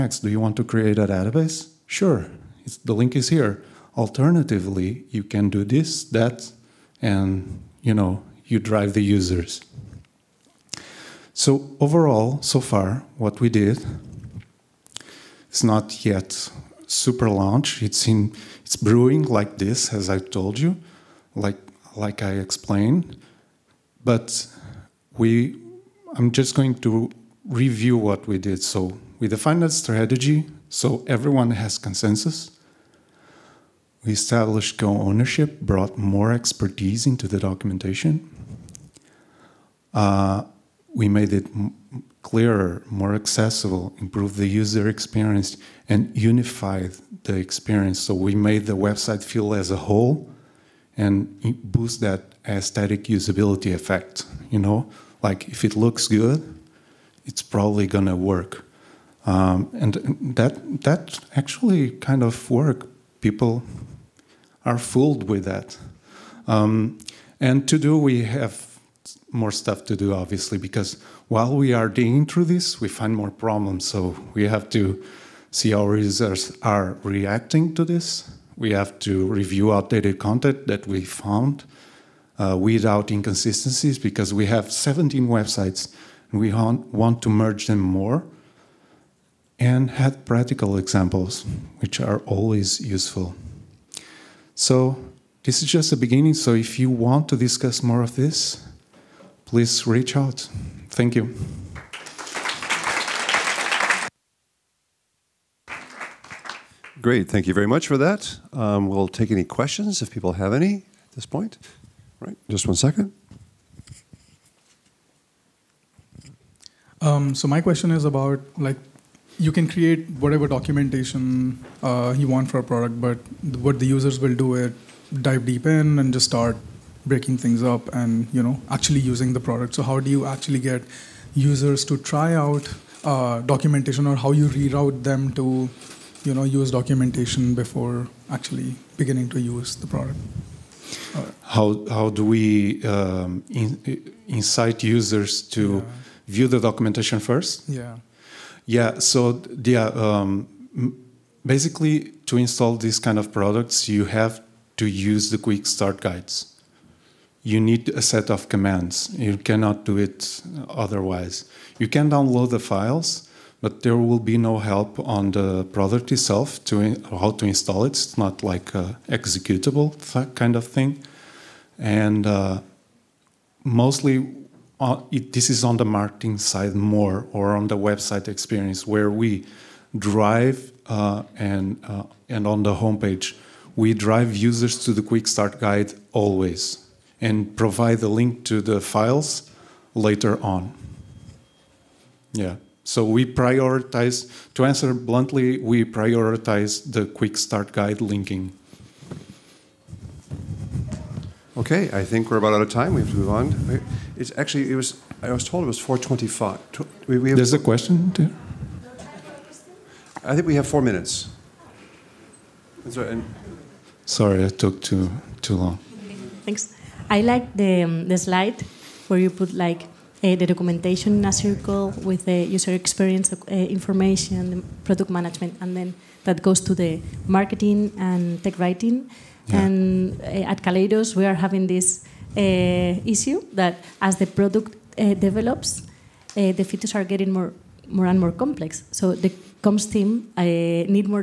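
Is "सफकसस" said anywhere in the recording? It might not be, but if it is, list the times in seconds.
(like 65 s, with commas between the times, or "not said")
not said.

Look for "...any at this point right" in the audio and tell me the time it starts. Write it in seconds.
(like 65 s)
110 s.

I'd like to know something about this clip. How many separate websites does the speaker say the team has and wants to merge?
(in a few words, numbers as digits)
17.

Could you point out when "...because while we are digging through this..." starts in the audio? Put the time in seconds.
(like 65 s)
70 s.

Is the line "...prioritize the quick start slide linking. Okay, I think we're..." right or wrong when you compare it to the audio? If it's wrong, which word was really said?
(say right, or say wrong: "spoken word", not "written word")
wrong: "guide", not "slide".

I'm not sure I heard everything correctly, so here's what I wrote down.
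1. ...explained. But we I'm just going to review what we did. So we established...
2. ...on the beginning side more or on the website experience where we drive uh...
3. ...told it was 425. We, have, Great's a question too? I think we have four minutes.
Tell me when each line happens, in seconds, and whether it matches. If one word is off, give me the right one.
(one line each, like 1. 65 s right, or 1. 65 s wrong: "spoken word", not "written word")
1. 22 s wrong: "defined", not "established"
2. 175 s wrong: "marketing", not "beginning"
3. 205 s wrong: "There", not "Great".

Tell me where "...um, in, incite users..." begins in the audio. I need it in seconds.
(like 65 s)
142 s.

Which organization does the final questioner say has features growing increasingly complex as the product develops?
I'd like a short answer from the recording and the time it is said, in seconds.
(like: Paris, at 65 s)
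Kaleidos, at 230 s.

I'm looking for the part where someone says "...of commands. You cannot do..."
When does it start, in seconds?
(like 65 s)
158 s.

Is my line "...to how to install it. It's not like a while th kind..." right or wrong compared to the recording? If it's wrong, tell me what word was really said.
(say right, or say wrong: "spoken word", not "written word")
wrong: "executable", not "while".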